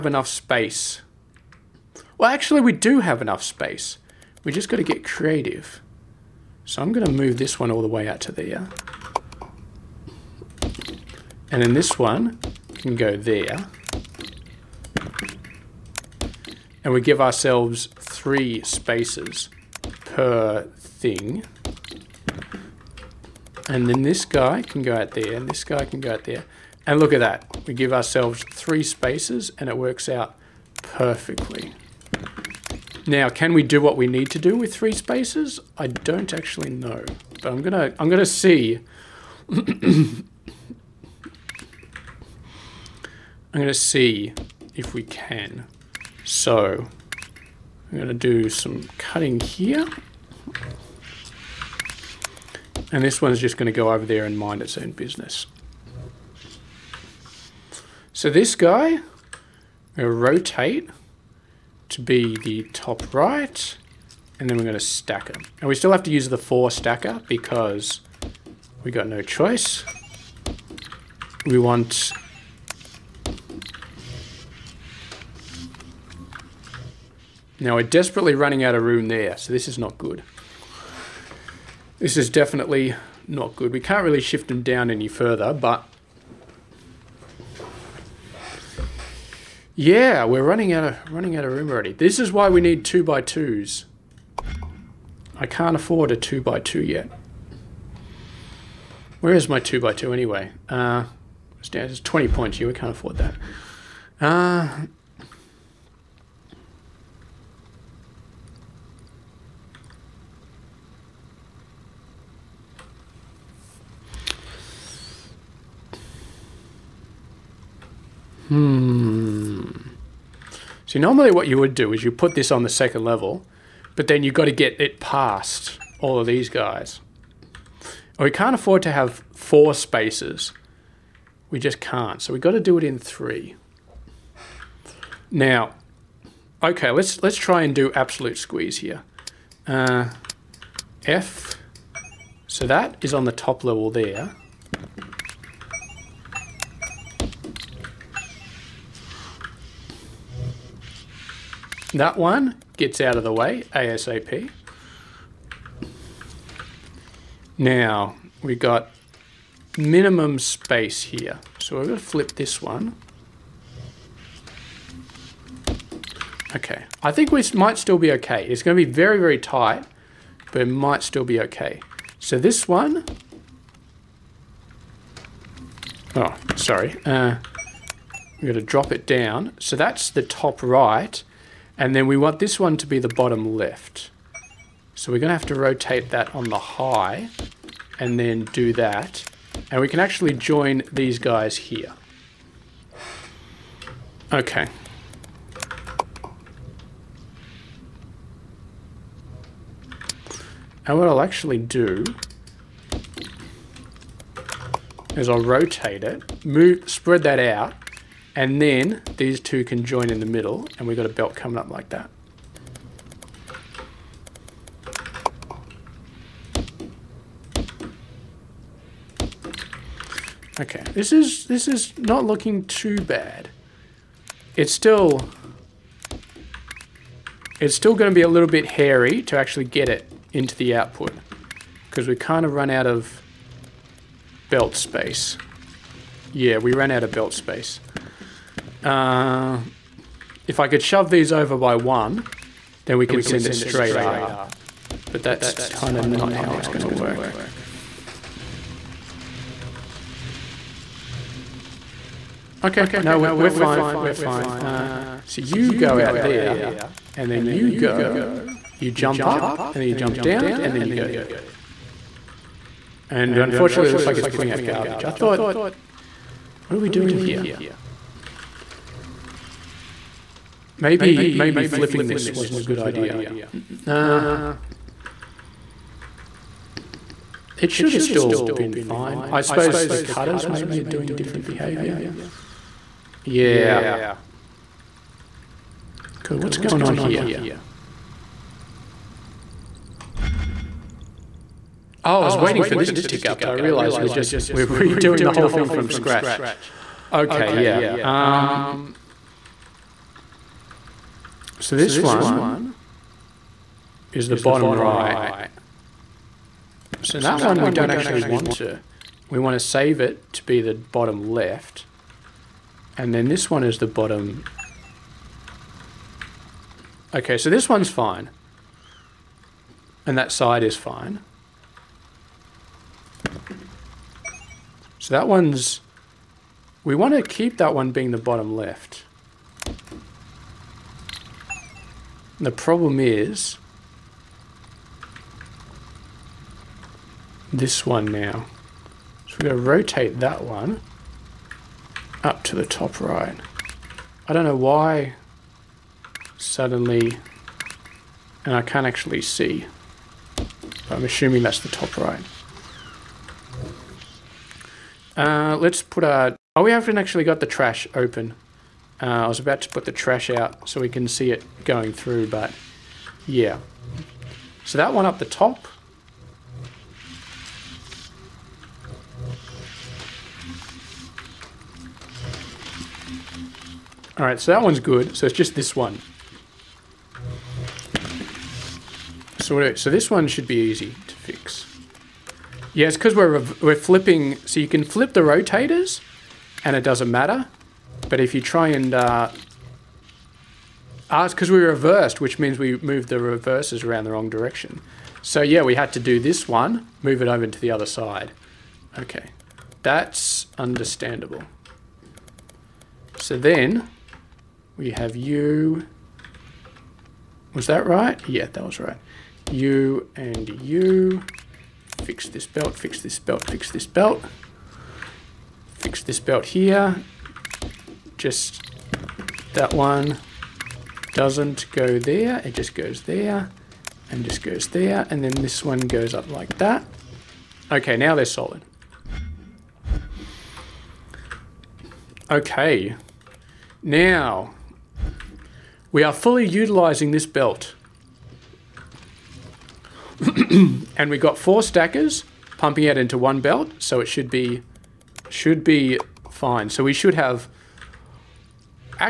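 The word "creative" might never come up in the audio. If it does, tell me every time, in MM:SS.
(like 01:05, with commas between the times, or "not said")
00:05.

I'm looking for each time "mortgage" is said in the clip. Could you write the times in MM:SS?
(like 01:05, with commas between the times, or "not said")
not said.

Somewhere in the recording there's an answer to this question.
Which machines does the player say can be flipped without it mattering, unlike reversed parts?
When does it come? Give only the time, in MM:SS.
06:25.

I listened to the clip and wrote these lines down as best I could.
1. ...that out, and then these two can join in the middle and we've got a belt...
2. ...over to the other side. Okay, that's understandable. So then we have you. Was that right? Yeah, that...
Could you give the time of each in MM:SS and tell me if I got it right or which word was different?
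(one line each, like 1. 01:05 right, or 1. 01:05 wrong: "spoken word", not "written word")
1. 03:27 right
2. 06:37 right.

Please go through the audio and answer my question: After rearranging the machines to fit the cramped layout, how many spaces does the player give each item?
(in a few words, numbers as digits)
3.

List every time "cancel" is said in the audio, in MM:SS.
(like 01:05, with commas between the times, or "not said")
not said.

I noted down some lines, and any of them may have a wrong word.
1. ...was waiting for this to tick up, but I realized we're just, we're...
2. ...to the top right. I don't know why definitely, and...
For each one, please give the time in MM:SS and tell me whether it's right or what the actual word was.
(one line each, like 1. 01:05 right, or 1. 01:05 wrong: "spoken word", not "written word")
1. 04:52 right
2. 05:42 wrong: "suddenly", not "definitely".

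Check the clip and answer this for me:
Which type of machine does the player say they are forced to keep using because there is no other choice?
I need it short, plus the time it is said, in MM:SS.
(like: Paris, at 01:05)
4 stacker, at 01:06.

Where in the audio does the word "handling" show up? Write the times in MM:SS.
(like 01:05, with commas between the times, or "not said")
not said.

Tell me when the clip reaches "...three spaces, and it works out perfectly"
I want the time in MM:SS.
00:28.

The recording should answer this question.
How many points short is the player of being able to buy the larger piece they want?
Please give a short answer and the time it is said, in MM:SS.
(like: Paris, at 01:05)
20, at 01:42.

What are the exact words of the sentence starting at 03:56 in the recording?
Yeah, we ran out of belt space.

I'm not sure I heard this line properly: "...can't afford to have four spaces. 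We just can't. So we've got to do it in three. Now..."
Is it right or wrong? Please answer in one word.
right.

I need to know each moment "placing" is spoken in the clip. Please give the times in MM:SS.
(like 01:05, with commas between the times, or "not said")
not said.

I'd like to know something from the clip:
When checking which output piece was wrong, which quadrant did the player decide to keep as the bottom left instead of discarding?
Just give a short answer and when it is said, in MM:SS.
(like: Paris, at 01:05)
bottom right, at 05:01.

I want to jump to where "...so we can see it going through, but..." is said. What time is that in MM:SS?
06:00.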